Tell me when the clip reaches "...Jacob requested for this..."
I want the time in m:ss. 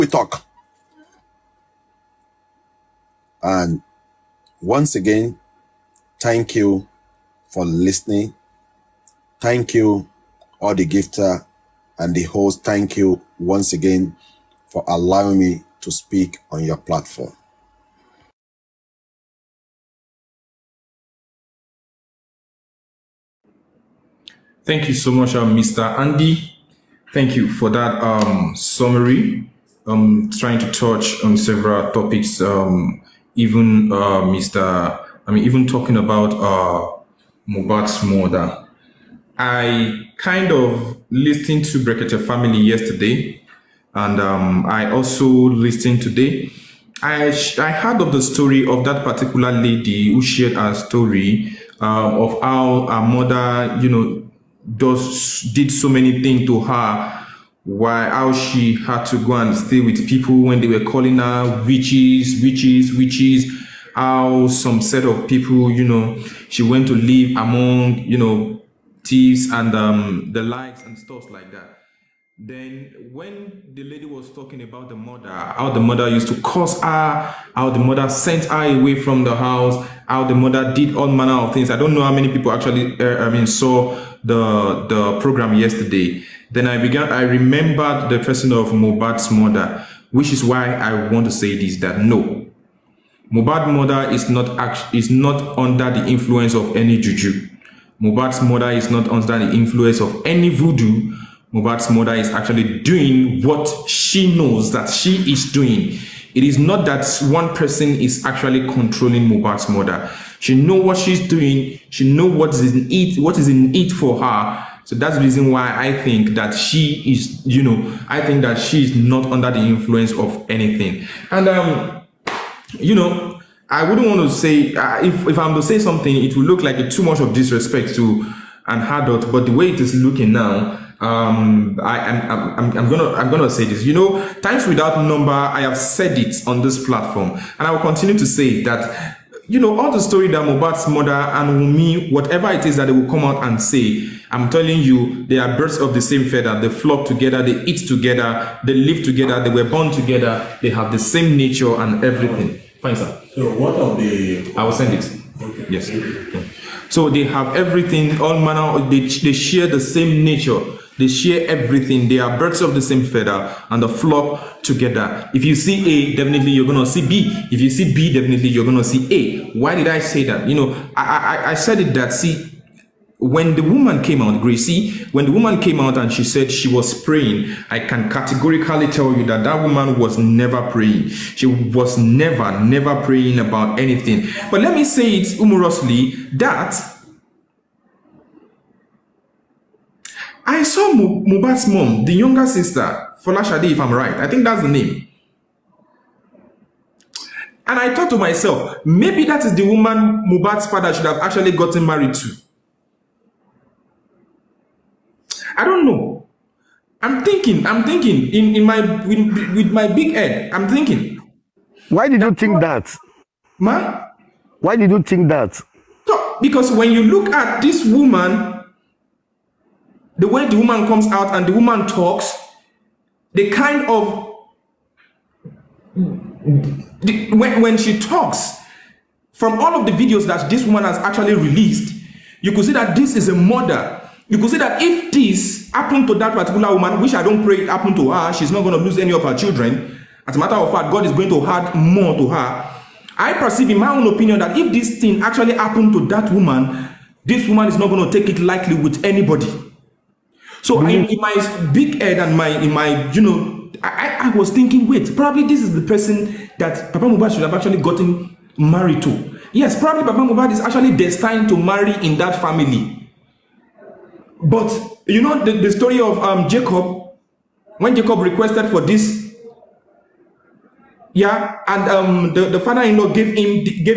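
4:27.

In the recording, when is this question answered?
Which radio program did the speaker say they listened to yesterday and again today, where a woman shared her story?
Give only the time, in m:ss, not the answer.
0:41.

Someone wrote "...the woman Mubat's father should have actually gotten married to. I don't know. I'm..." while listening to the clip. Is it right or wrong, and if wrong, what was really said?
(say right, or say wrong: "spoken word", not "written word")
right.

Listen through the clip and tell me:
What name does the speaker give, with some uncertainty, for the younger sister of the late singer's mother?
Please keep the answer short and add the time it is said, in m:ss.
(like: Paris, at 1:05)
Folashade, at 3:13.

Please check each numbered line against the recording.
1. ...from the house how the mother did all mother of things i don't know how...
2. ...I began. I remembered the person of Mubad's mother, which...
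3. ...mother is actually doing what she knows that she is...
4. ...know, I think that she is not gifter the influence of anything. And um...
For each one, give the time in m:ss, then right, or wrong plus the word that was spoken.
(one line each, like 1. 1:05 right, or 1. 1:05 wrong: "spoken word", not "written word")
1. 1:18 wrong: "manner", not "mother"
2. 1:26 wrong: "Mohbad", not "Mubad"
3. 1:41 right
4. 1:57 wrong: "under", not "gifter".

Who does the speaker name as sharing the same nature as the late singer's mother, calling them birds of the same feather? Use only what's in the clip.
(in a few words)
Wumi.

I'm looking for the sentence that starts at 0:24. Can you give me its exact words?
Thank you so much, uh, um, Mr.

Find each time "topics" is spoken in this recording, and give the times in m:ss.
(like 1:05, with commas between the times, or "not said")
0:31.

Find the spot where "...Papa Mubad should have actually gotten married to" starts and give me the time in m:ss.
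4:16.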